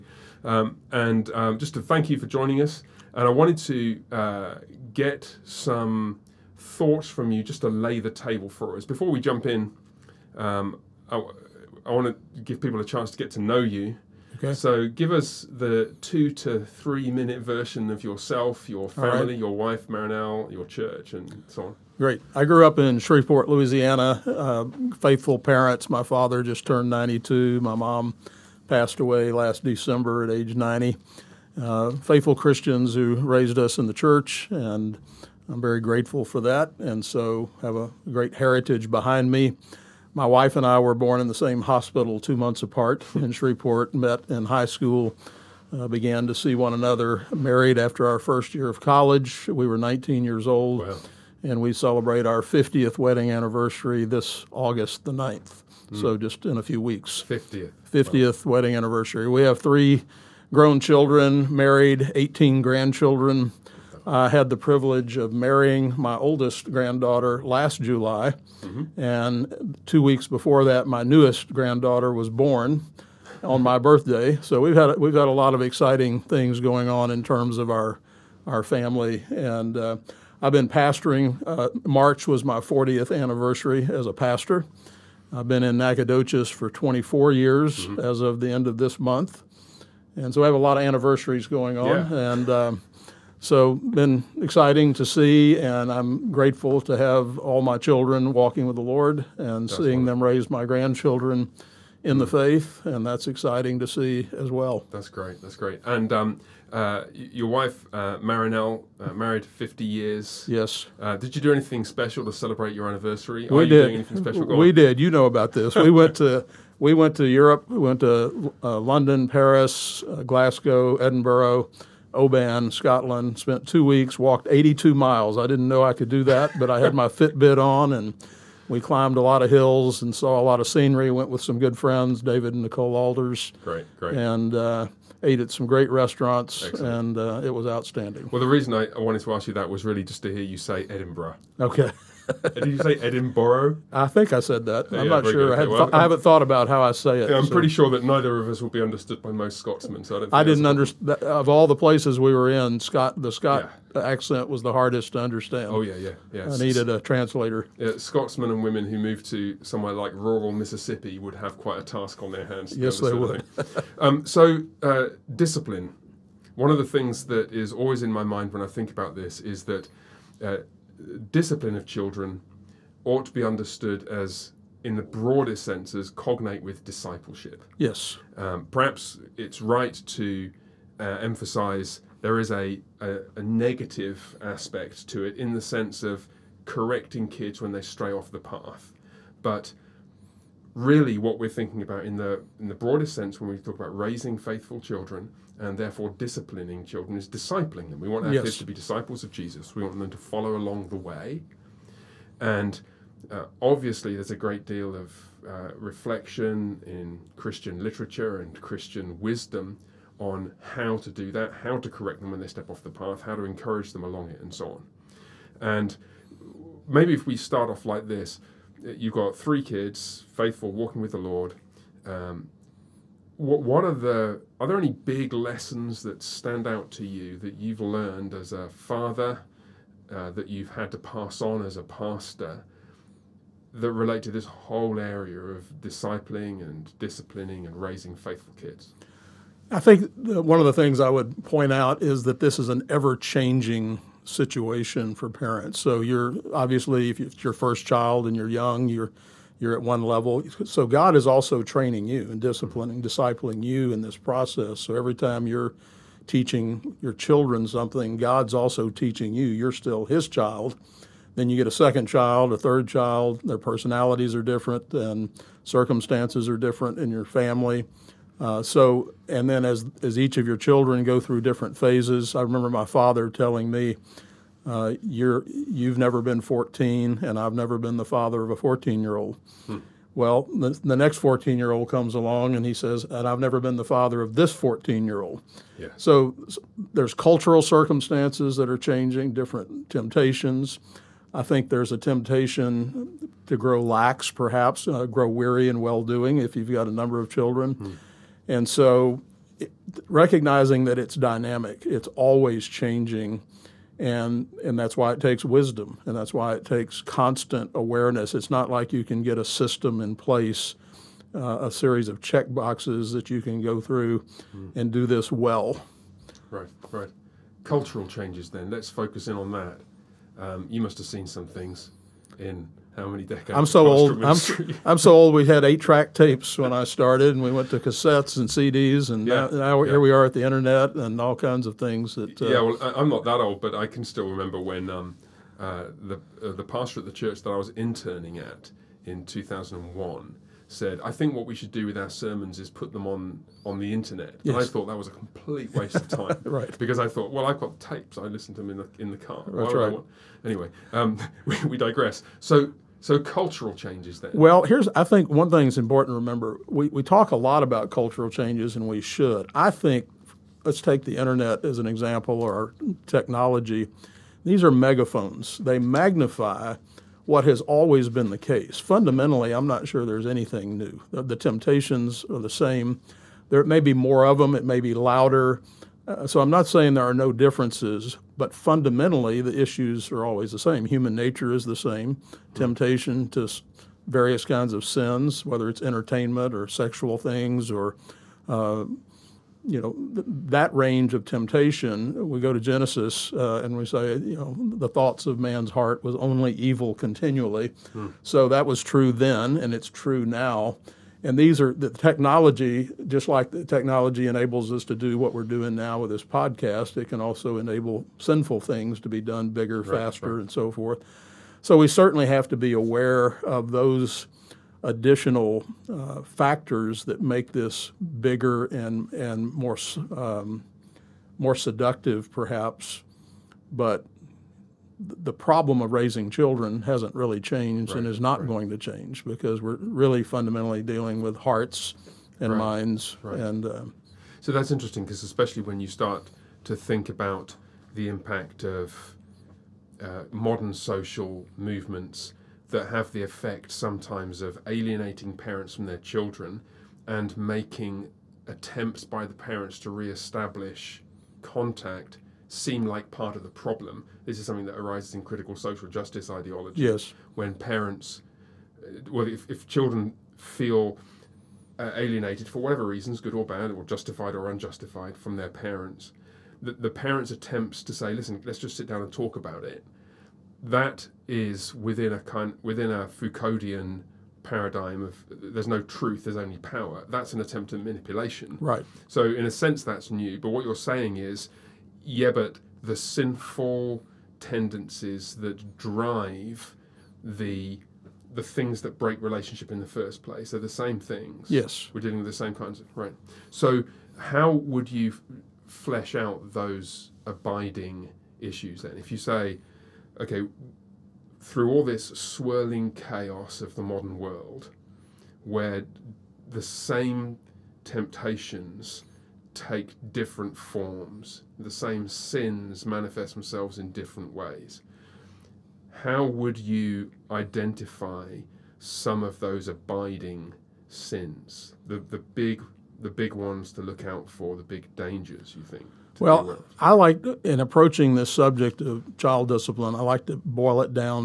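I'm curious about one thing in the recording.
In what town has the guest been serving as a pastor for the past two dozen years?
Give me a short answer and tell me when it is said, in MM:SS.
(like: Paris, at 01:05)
Nacogdoches, at 01:25.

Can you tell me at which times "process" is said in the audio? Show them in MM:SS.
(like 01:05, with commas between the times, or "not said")
04:14.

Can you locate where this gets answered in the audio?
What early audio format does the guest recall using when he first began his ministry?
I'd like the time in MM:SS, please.
05:25.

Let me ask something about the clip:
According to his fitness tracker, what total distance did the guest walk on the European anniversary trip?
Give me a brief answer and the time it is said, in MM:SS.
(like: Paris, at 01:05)
82 miles, at 02:04.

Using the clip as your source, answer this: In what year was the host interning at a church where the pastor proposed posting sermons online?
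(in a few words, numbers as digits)
2001.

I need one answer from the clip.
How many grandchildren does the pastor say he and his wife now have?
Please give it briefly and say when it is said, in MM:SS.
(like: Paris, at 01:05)
18, at 01:02.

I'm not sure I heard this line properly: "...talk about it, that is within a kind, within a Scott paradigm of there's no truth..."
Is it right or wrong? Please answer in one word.
wrong.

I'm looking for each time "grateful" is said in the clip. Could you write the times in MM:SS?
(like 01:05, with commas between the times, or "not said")
00:35, 01:36.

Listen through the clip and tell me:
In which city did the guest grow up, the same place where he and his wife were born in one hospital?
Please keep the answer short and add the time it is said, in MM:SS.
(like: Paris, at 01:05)
Shreveport, Louisiana, at 00:22.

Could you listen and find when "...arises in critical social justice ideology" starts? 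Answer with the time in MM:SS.
07:34.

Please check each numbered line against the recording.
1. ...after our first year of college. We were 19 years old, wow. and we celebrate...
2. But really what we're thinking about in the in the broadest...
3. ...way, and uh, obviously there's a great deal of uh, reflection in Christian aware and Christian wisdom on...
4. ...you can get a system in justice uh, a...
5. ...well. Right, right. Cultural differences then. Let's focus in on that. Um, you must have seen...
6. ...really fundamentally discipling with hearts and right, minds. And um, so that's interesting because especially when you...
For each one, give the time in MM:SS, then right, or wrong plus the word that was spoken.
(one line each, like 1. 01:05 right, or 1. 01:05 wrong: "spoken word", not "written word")
1. 00:47 right
2. 03:09 right
3. 03:20 wrong: "literature", not "aware"
4. 05:08 wrong: "place", not "justice"
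5. 05:15 wrong: "changes", not "differences"
6. 07:09 wrong: "dealing", not "discipling".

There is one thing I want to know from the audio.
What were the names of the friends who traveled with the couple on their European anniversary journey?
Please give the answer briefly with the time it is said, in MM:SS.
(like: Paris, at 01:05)
David and Nicole Alders, at 02:12.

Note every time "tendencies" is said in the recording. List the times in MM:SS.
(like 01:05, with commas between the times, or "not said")
08:04.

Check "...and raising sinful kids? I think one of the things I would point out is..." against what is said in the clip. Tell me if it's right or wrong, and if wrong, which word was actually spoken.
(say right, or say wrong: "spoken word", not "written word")
wrong: "faithful", not "sinful".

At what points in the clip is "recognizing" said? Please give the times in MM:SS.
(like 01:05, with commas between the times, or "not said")
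05:00.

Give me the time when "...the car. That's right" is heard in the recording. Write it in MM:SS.
05:49.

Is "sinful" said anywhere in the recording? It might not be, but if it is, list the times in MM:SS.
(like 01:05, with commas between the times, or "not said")
06:48, 08:02.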